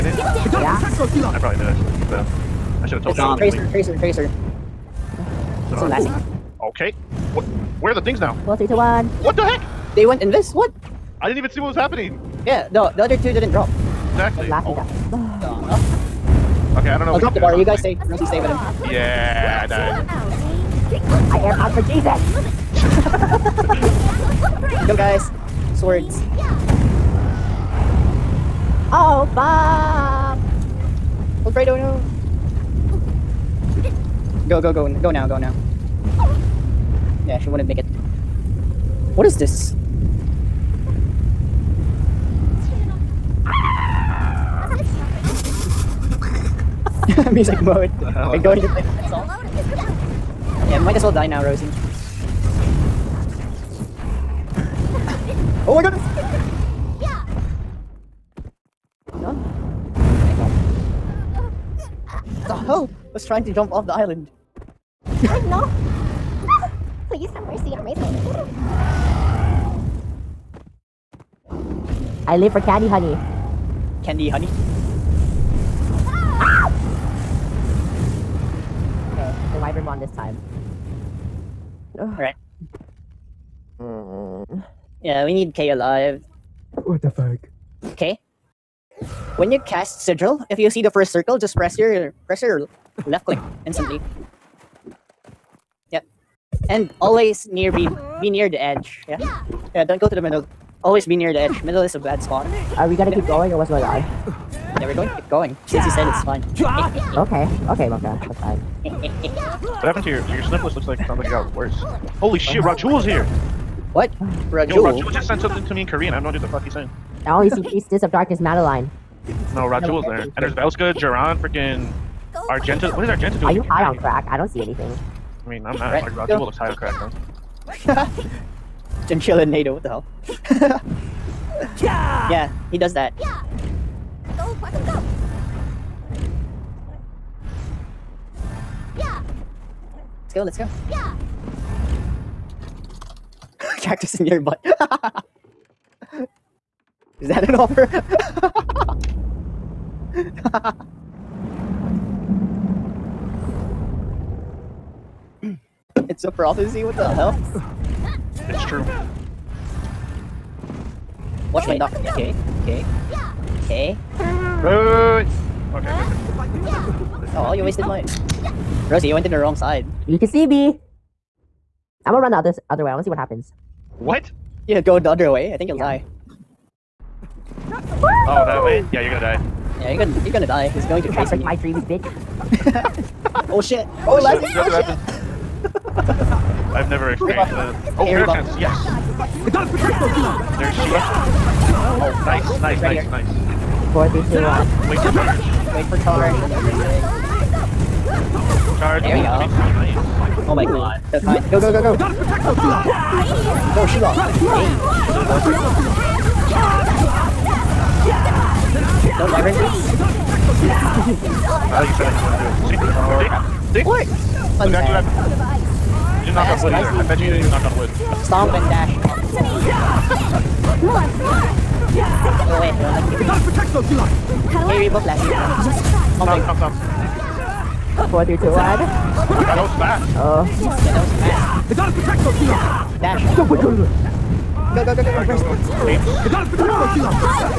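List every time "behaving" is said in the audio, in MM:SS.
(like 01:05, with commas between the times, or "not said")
not said.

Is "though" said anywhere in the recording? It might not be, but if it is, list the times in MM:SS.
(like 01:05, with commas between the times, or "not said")
02:06.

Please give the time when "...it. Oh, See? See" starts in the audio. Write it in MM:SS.
03:32.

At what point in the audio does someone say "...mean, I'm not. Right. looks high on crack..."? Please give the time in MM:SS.
02:05.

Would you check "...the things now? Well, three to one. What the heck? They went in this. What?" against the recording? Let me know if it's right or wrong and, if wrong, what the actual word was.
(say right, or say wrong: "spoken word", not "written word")
right.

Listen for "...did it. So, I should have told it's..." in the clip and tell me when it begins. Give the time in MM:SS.
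00:01.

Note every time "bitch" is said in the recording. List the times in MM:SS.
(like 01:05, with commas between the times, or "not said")
03:01.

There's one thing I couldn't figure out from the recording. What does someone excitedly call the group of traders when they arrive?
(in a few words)
Harry Merchants.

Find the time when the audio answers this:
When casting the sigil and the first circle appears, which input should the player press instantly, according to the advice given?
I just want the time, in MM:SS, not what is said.
01:33.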